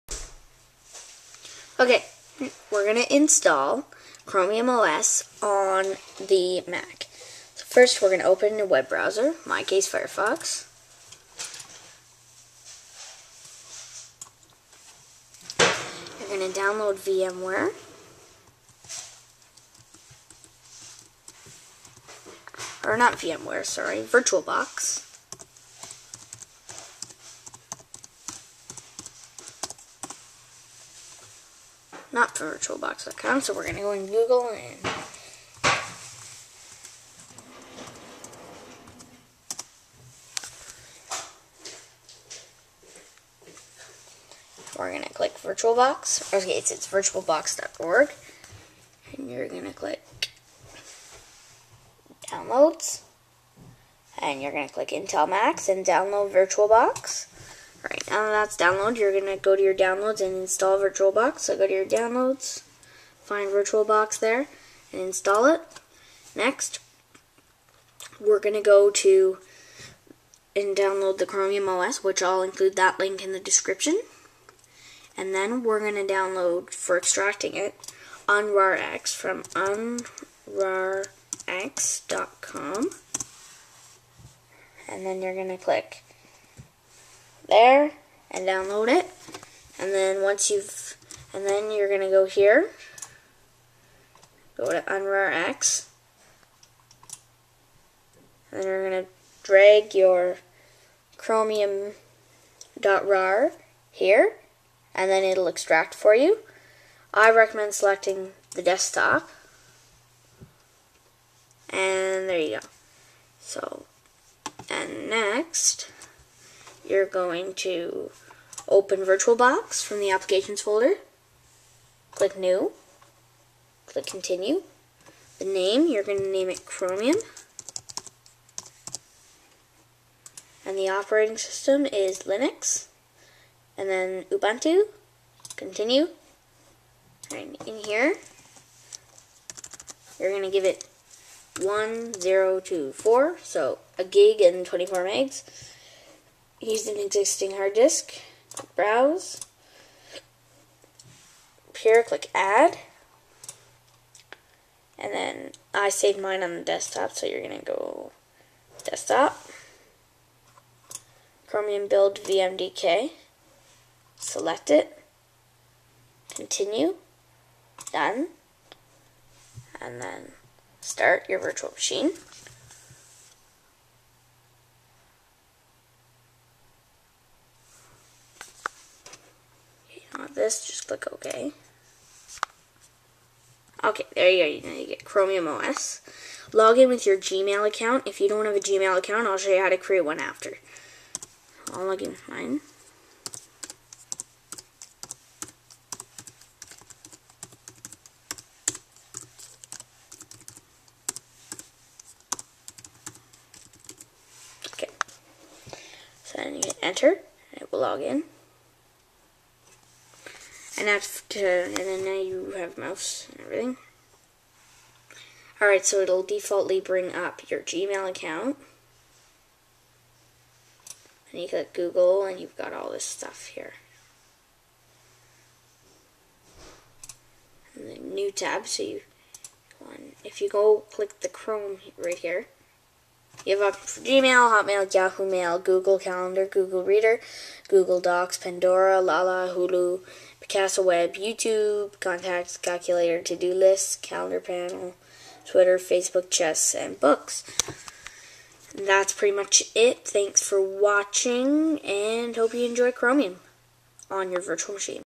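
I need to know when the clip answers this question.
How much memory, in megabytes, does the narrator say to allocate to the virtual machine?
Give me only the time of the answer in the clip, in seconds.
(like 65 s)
141 s.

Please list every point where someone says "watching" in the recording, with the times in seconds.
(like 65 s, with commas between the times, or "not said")
250 s.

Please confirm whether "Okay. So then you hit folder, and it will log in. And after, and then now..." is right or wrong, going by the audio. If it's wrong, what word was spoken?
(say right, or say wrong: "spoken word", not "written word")
wrong: "enter", not "folder".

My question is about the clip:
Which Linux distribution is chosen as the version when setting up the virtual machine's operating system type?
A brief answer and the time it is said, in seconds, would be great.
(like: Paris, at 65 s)
Ubuntu, at 134 s.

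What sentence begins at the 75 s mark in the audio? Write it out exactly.
And then we're going to download, for extracting it, unrarx from unrarx.com.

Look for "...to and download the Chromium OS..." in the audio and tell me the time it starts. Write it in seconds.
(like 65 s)
68 s.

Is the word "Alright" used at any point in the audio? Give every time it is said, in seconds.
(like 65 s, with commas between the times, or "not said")
57 s, 215 s.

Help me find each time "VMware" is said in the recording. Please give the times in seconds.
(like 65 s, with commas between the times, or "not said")
16 s, 23 s.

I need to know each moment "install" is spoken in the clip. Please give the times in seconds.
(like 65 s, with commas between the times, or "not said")
3 s, 60 s, 65 s.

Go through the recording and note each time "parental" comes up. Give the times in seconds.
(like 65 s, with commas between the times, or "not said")
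not said.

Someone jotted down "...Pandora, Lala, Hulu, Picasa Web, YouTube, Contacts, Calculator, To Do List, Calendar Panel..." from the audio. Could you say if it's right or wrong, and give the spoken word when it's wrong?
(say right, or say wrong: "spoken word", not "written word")
right.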